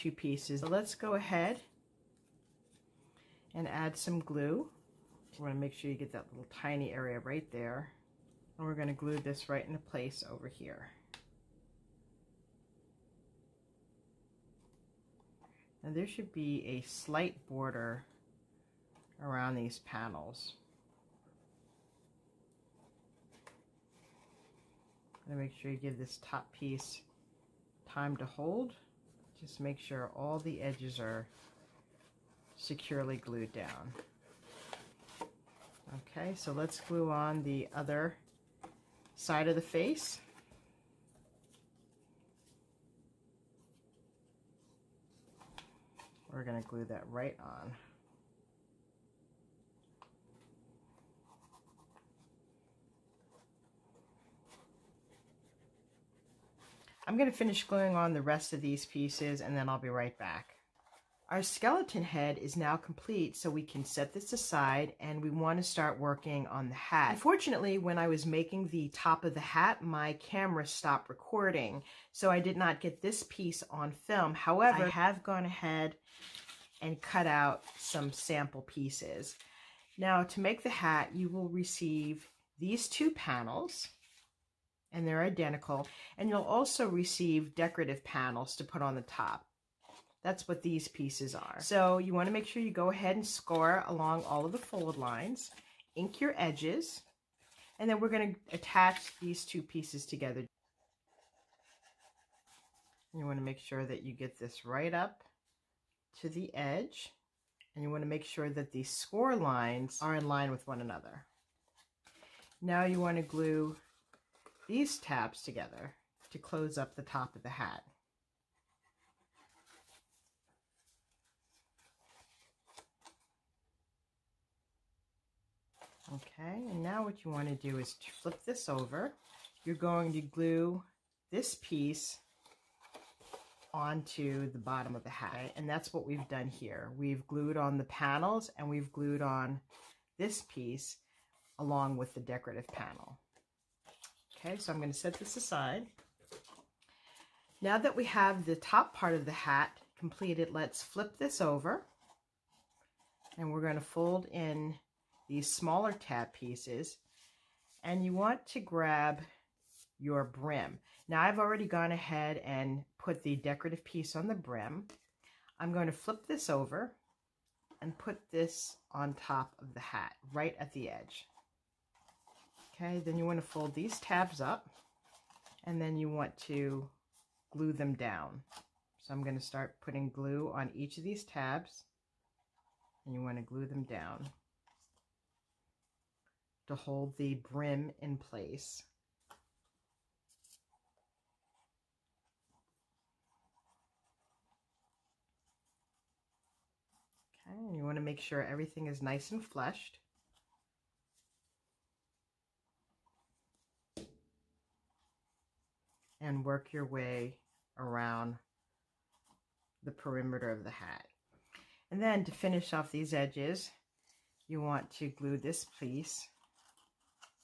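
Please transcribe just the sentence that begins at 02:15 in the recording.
And that's what we've done here.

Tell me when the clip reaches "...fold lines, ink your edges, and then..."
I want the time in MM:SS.
01:34.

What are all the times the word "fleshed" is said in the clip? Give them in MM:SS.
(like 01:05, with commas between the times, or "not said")
03:19.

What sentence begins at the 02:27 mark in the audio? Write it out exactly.
Now that we have the top part of the hat completed, let's flip this over.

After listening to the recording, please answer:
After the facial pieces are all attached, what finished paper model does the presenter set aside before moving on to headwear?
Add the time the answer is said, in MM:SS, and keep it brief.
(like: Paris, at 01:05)
skeleton head, at 01:01.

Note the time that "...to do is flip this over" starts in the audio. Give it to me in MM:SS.
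02:07.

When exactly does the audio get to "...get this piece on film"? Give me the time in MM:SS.
01:12.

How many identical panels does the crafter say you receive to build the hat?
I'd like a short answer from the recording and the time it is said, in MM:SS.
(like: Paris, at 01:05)
2, at 01:22.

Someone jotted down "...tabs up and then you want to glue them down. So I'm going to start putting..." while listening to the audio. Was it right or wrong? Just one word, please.
right.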